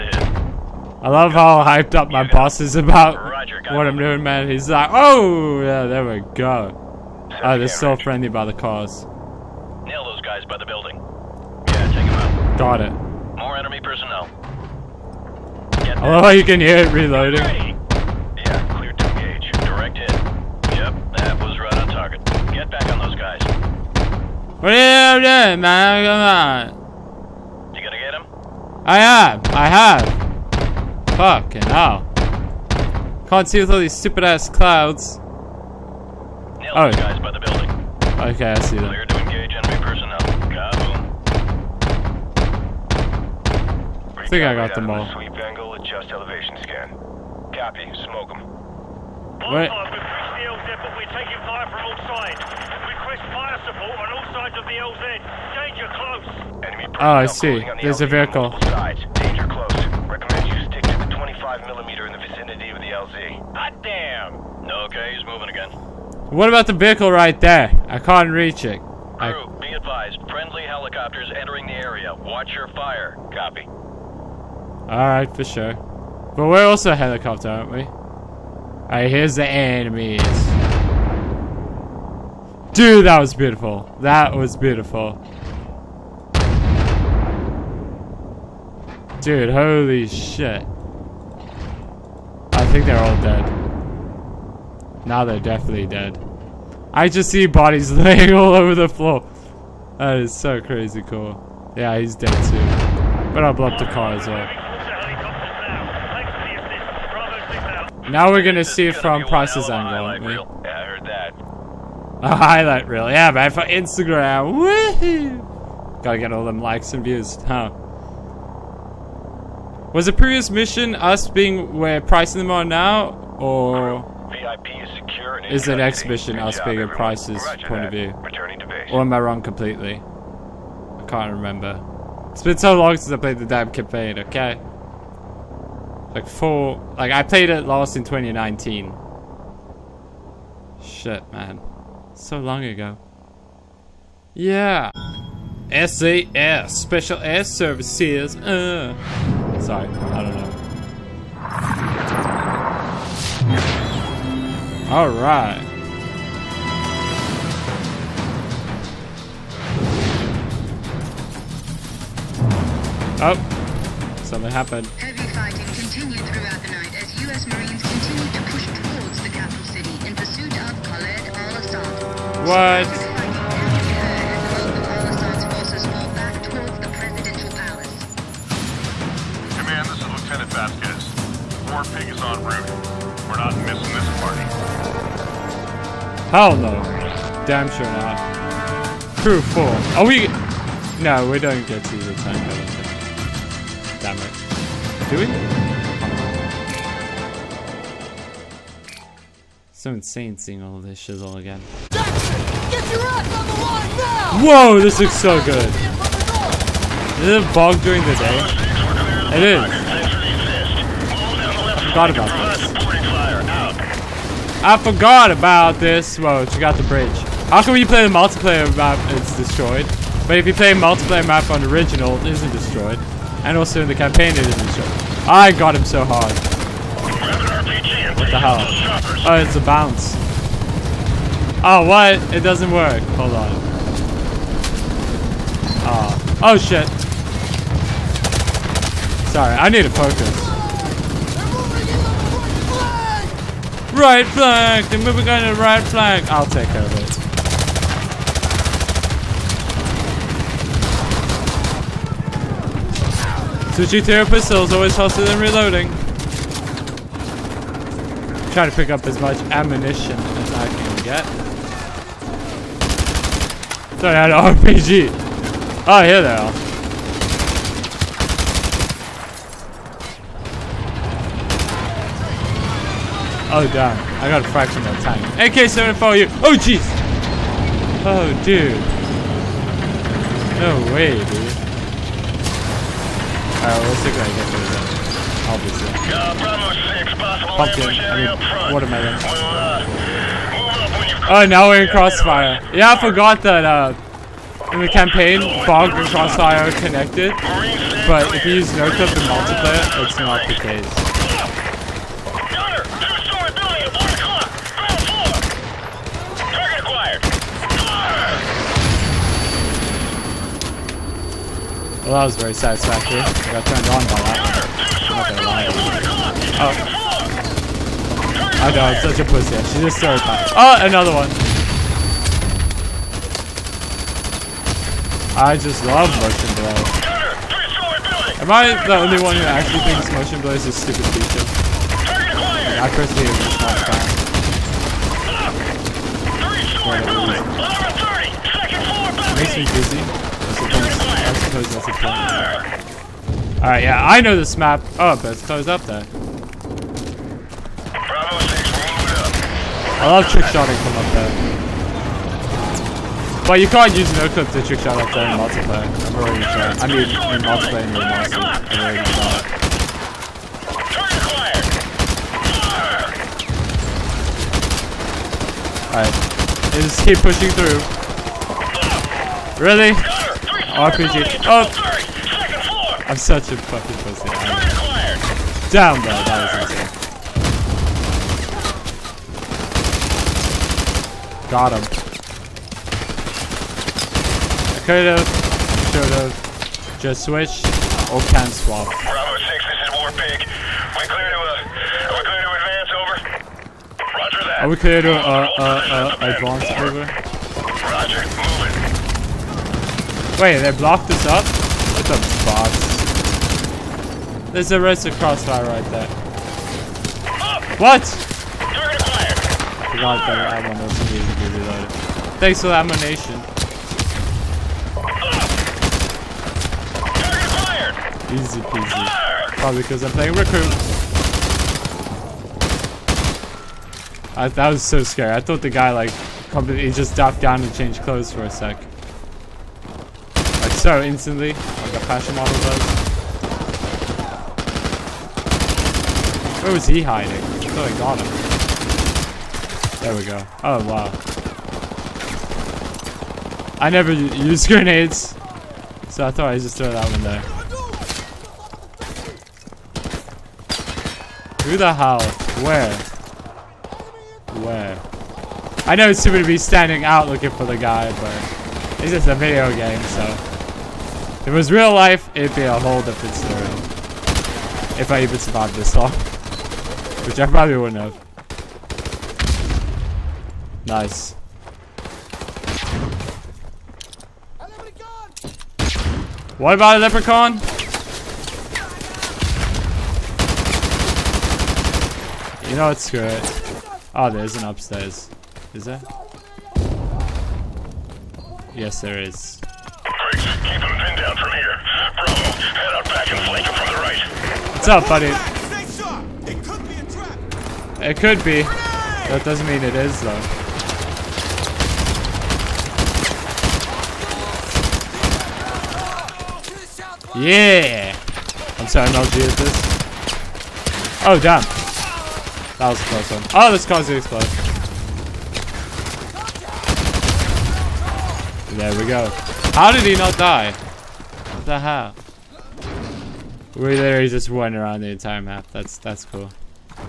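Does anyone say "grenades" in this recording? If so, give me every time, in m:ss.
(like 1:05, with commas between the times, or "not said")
7:24.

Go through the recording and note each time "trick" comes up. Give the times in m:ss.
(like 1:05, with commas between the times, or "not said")
5:50, 5:54.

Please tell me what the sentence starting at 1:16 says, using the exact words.
But we're also a helicopter, aren't we?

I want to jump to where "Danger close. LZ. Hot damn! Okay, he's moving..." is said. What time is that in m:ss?
0:59.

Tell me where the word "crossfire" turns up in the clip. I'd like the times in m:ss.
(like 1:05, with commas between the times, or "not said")
4:51, 4:56, 6:45.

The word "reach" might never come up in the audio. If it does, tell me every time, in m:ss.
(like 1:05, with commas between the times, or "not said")
1:08.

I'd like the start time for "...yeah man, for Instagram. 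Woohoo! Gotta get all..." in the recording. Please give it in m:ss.
1:53.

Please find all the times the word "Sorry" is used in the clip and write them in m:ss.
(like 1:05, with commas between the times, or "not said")
3:59, 4:24.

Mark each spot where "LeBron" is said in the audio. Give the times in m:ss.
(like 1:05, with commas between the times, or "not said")
not said.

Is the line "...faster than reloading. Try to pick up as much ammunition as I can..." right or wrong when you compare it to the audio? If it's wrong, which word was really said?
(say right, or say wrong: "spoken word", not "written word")
right.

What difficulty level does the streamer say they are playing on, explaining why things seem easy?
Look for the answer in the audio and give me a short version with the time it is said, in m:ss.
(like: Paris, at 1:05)
Recruit, at 7:00.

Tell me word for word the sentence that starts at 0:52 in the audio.
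Request fire support on all sides of the LZ.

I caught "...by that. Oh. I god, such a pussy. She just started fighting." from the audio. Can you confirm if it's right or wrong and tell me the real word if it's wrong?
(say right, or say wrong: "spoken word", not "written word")
right.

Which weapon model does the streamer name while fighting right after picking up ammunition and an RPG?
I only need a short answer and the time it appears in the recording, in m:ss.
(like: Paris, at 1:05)
AK-74, at 4:35.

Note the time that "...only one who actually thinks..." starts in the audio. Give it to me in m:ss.
5:28.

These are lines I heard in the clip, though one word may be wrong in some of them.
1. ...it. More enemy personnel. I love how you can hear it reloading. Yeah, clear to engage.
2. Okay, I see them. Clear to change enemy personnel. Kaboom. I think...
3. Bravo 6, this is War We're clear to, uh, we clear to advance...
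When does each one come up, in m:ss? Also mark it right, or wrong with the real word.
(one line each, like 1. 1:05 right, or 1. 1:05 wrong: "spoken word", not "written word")
1. 0:12 right
2. 0:38 wrong: "engage", not "change"
3. 6:28 right.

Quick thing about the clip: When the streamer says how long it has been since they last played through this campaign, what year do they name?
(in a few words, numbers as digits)
2019.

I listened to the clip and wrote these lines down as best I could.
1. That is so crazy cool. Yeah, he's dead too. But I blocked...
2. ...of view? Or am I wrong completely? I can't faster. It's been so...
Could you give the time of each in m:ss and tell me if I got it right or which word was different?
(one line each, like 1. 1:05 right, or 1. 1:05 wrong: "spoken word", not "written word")
1. 1:39 right
2. 2:07 wrong: "remember", not "faster".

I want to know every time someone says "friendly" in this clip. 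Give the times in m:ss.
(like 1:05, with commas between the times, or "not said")
0:07, 1:10.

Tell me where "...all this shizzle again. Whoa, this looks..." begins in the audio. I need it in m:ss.
3:20.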